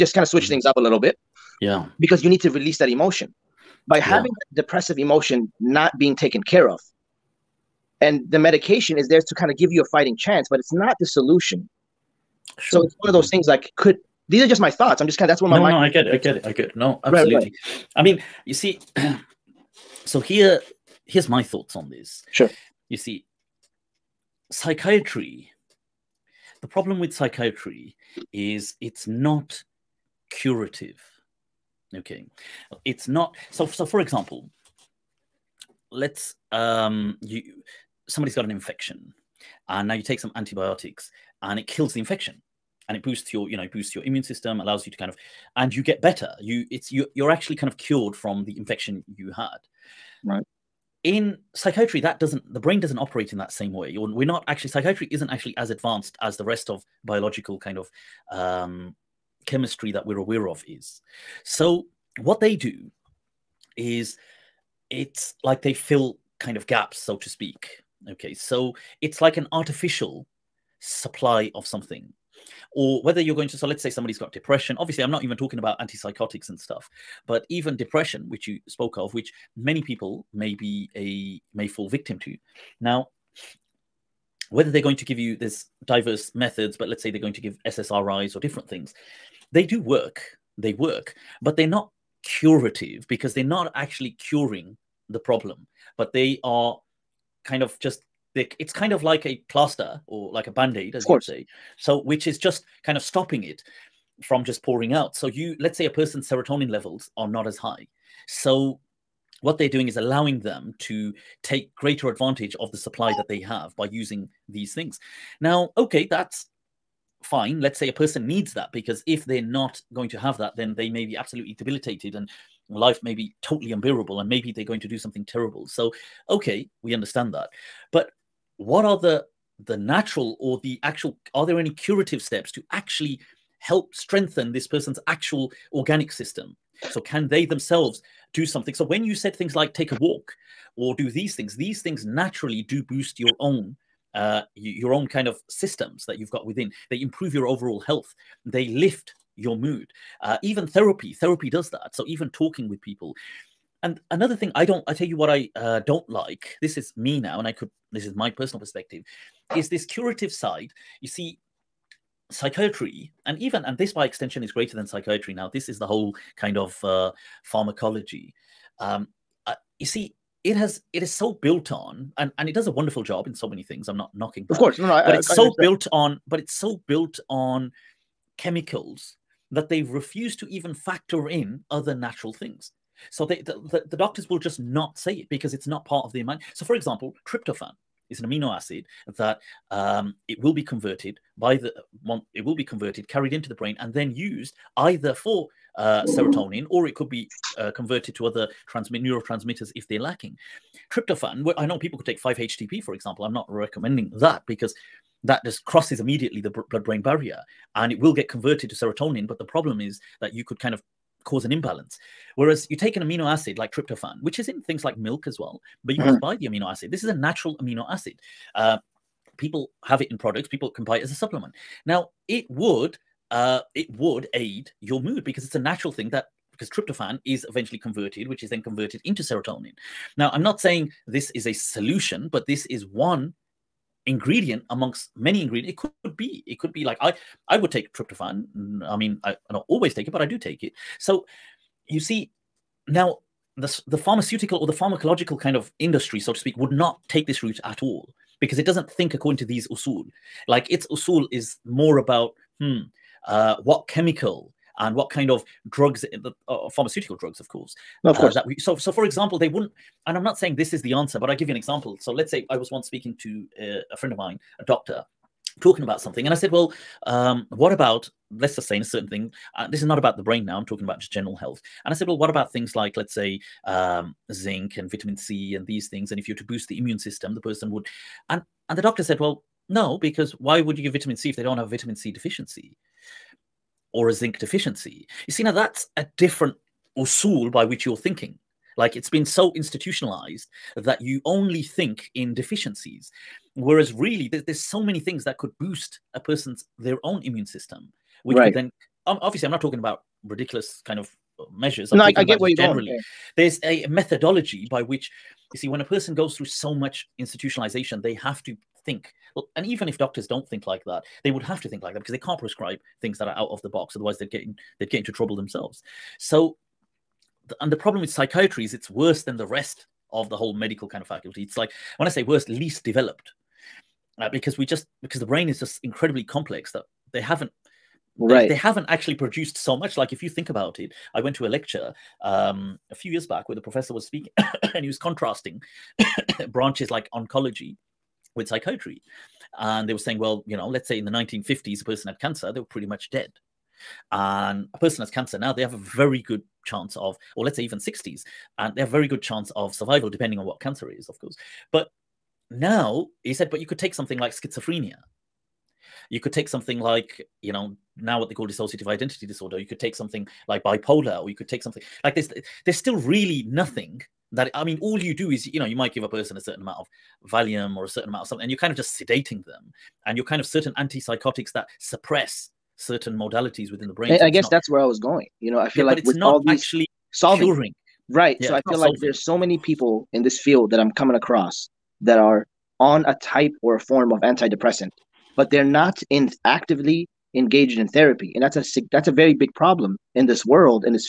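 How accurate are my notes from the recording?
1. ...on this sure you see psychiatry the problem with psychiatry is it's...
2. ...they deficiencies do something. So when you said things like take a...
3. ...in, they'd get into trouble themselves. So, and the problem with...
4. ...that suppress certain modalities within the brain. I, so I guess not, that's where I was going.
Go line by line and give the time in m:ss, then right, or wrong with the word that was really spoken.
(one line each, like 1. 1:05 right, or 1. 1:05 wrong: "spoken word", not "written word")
1. 0:21 right
2. 2:17 wrong: "themselves", not "deficiencies"
3. 5:14 right
4. 6:11 right.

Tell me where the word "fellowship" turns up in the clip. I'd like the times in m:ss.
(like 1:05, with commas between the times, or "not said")
not said.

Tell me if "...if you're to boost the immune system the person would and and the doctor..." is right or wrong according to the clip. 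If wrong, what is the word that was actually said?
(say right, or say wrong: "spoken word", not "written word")
right.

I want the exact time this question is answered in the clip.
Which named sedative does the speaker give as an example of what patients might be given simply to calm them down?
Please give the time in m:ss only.
6:07.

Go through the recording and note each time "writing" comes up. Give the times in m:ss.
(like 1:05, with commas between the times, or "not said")
not said.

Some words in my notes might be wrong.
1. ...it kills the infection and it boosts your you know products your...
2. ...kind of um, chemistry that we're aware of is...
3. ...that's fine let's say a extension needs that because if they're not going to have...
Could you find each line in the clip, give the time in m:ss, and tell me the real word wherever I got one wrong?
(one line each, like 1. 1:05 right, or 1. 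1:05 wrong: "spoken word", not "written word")
1. 0:41 wrong: "boosts", not "products"
2. 0:57 right
3. 1:56 wrong: "person", not "extension".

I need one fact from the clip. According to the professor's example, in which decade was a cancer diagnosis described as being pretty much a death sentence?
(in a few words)
1950s.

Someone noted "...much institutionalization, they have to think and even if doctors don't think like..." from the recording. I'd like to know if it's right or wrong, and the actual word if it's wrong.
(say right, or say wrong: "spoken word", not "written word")
right.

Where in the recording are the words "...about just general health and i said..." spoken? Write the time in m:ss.
4:30.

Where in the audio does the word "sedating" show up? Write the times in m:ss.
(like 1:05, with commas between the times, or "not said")
6:08.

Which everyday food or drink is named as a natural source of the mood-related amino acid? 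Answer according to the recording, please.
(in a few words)
milk.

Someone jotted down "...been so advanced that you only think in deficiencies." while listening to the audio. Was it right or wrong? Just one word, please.
wrong.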